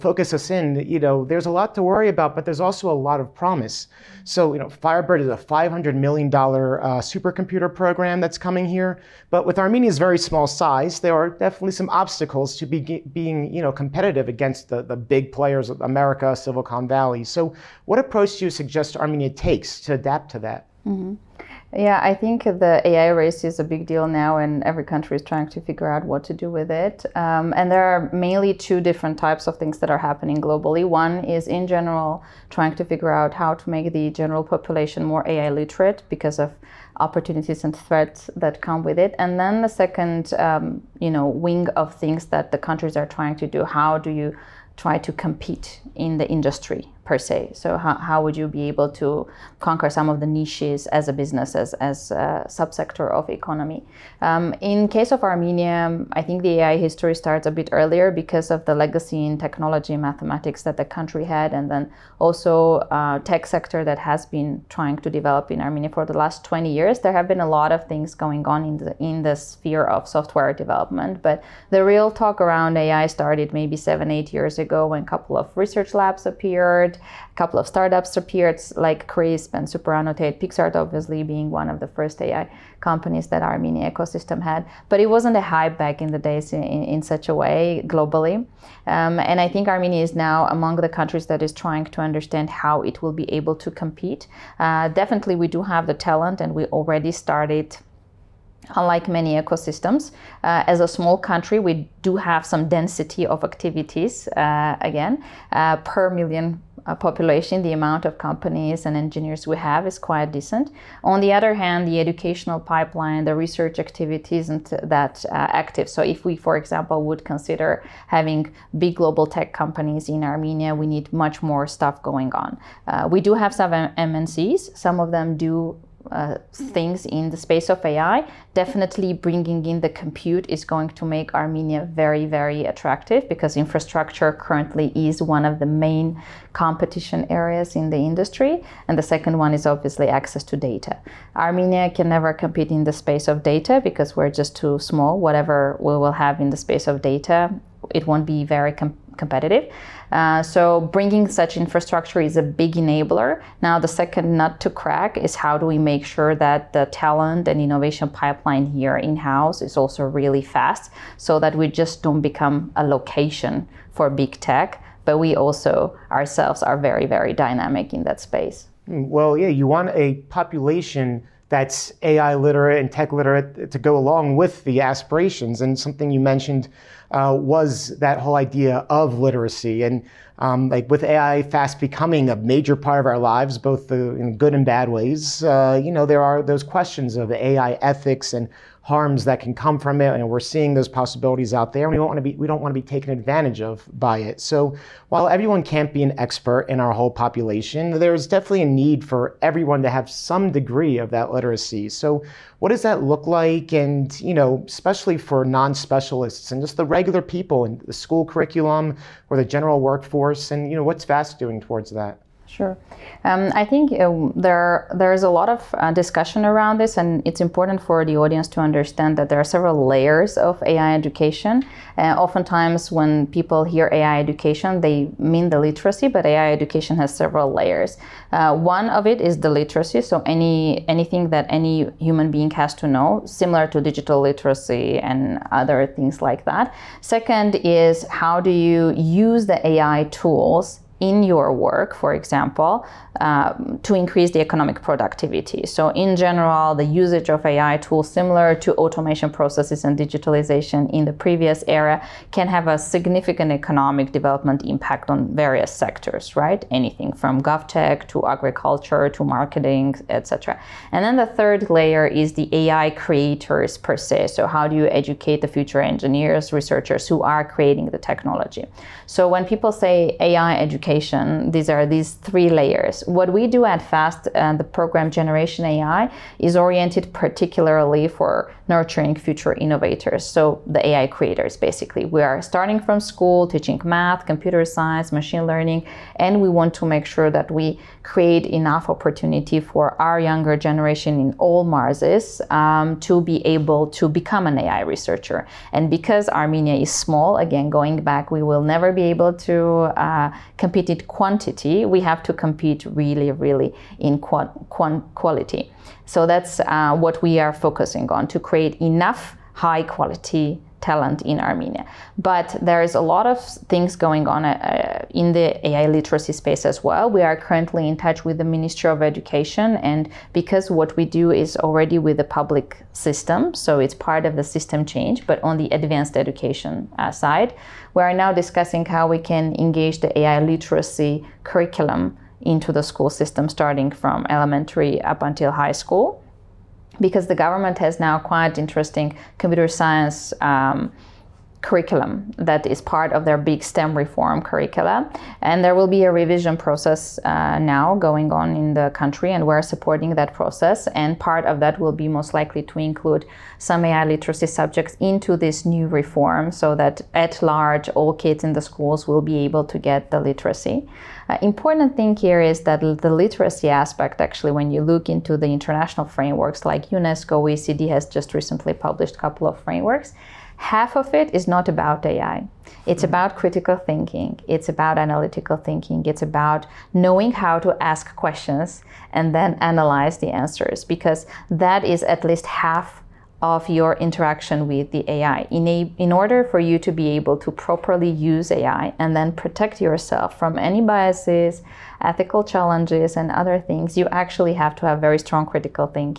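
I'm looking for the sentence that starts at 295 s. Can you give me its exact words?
And because Armenia is small, again, going back, we will never be able to uh, compete in quantity.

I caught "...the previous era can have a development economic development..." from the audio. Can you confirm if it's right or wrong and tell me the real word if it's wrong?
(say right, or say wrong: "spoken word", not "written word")
wrong: "significant", not "development".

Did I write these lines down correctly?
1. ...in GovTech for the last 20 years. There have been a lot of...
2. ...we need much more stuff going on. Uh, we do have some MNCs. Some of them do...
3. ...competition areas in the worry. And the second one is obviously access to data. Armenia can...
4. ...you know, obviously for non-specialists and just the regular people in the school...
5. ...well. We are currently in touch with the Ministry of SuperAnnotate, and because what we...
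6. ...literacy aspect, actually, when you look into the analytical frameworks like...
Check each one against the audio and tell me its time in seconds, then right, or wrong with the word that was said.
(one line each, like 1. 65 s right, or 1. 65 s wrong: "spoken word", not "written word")
1. 65 s wrong: "Armenia", not "GovTech"
2. 120 s right
3. 136 s wrong: "industry", not "worry"
4. 204 s wrong: "especially", not "obviously"
5. 316 s wrong: "Education", not "SuperAnnotate"
6. 363 s wrong: "international", not "analytical".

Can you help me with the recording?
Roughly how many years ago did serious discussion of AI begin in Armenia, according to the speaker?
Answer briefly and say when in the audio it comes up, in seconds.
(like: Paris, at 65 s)
7-8 years, at 73 s.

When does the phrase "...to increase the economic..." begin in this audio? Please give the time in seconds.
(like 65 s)
243 s.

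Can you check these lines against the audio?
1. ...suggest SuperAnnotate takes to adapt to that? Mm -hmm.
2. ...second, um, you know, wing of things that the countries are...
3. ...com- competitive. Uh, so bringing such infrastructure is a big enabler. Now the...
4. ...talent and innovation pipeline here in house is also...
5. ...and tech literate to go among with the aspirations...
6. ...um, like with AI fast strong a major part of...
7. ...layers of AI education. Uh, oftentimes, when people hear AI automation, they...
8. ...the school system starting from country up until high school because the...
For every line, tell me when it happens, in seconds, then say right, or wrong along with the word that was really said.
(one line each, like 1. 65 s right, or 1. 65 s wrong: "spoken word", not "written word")
1. 18 s wrong: "Armenia", not "SuperAnnotate"
2. 39 s right
3. 148 s right
4. 156 s right
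5. 172 s wrong: "along", not "among"
6. 180 s wrong: "becoming", not "strong"
7. 219 s wrong: "education", not "automation"
8. 332 s wrong: "elementary", not "country".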